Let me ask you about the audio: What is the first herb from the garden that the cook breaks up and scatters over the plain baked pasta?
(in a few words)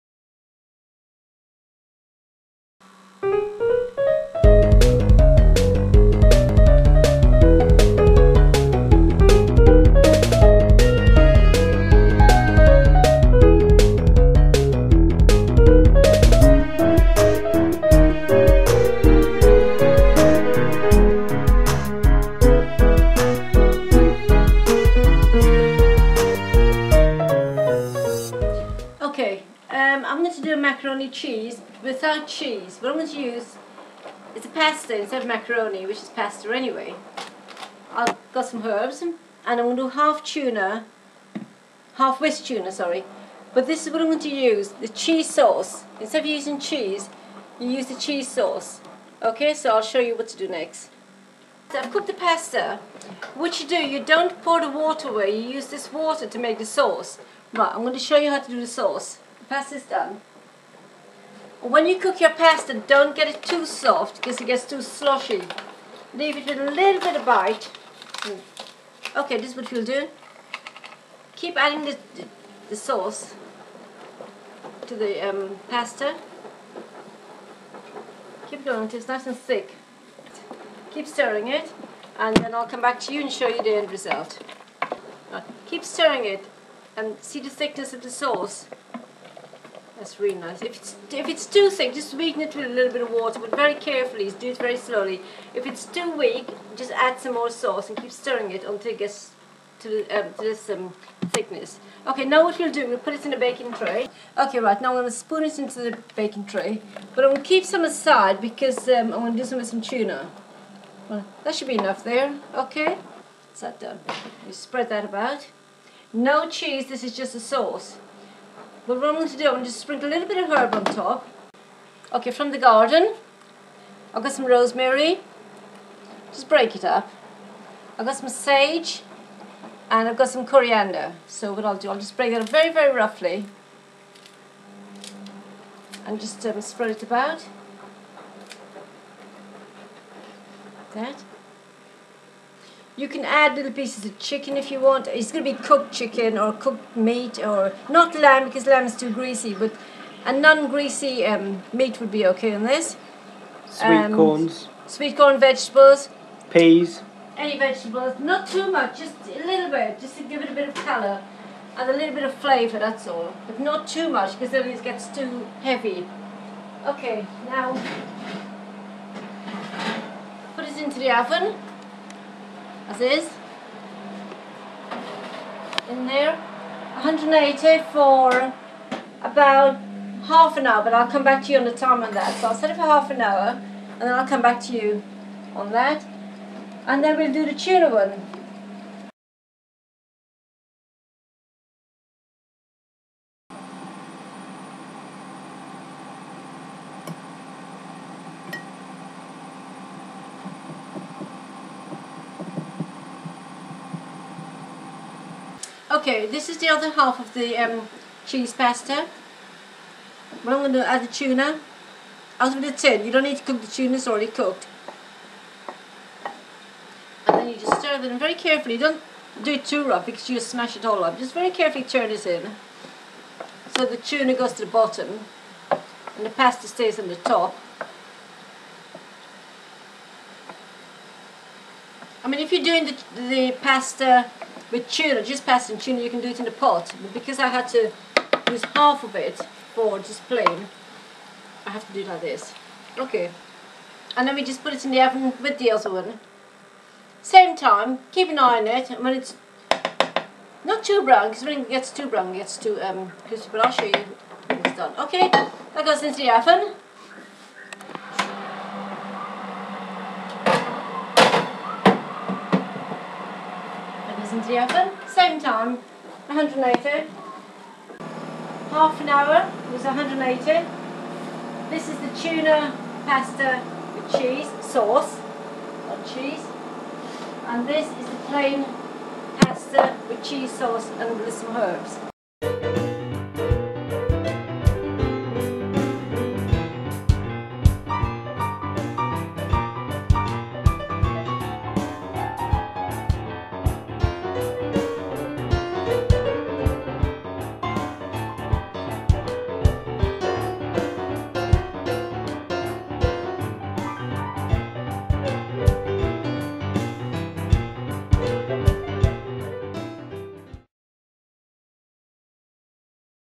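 rosemary.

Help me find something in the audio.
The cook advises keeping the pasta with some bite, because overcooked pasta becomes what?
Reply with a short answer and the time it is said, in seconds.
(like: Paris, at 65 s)
sloshy, at 64 s.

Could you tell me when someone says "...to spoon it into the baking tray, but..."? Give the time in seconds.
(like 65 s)
105 s.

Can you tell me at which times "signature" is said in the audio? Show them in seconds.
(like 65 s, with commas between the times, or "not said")
not said.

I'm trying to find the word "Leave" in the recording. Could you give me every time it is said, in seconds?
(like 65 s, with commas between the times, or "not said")
66 s.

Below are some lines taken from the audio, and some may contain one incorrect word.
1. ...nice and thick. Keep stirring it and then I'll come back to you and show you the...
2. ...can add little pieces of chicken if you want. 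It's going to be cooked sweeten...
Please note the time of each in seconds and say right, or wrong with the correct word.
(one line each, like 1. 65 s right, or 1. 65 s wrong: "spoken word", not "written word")
1. 79 s right
2. 143 s wrong: "chicken", not "sweeten".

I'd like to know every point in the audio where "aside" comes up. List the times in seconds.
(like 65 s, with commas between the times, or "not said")
107 s.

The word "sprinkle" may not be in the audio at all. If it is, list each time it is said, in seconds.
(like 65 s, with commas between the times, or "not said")
119 s.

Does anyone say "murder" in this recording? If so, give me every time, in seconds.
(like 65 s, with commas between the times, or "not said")
not said.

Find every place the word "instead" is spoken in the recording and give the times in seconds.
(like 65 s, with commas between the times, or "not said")
34 s, 46 s.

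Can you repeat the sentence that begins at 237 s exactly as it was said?
But because I had to use half of it for just plain, I have to do it like this.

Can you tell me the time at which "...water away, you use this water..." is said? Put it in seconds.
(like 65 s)
54 s.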